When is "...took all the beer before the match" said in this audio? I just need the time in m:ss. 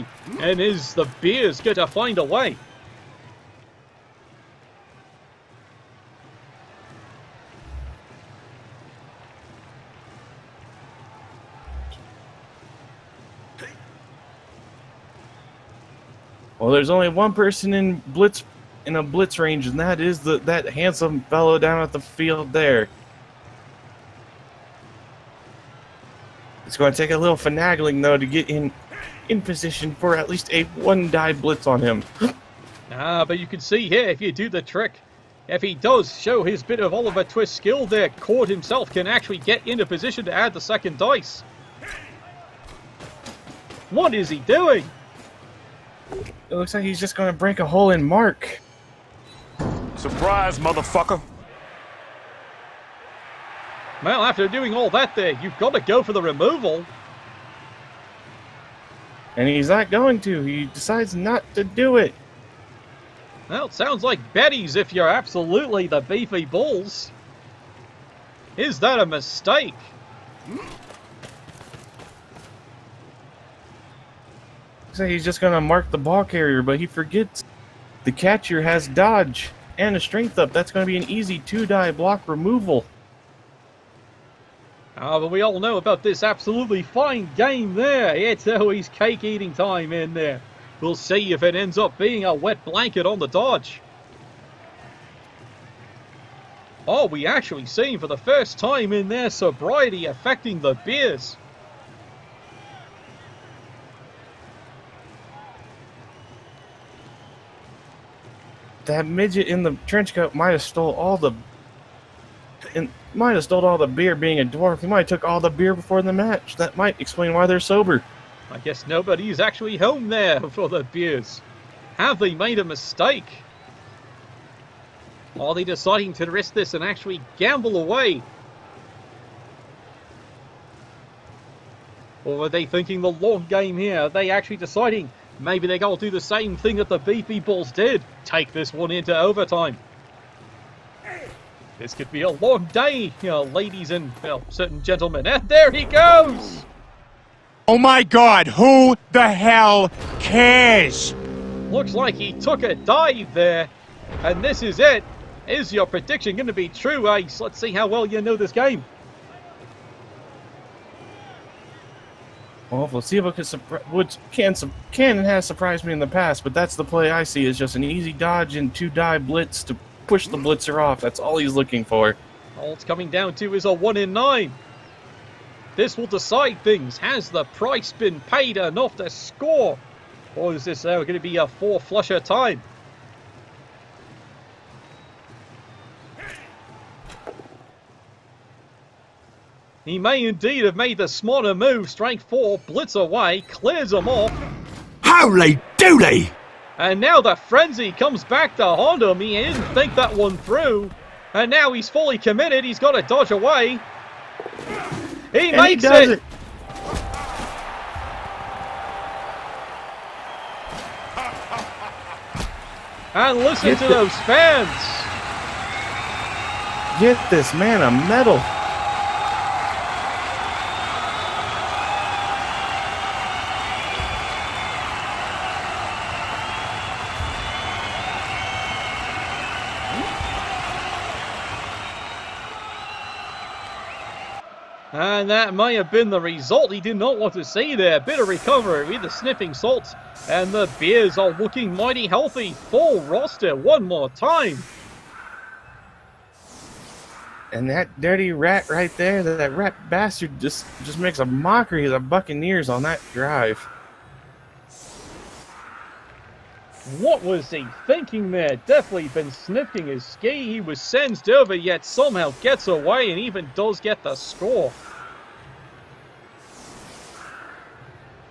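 1:55.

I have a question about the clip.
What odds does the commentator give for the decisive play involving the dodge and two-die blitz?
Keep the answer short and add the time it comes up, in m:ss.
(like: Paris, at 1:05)
1 in 9, at 2:53.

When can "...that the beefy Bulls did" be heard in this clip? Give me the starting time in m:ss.
2:16.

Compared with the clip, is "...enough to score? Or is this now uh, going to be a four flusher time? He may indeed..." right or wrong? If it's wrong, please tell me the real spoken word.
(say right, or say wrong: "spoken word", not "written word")
right.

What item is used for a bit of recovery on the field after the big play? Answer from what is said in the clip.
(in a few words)
Sniffing salt.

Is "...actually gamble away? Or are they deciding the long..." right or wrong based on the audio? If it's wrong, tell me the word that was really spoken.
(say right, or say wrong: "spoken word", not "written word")
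wrong: "thinking", not "deciding".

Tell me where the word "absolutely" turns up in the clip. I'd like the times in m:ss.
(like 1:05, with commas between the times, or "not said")
1:05, 1:26.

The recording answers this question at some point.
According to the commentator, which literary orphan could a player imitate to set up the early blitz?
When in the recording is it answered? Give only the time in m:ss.
0:36.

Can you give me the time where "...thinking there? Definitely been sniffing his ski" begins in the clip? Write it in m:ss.
4:17.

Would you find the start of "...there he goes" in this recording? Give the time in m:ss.
2:25.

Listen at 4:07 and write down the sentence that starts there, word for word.
And that dirty rat right there, that, that rat bastard just just makes a mockery of the Buccaneers on that drive.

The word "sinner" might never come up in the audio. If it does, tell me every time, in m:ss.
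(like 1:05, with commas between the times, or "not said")
not said.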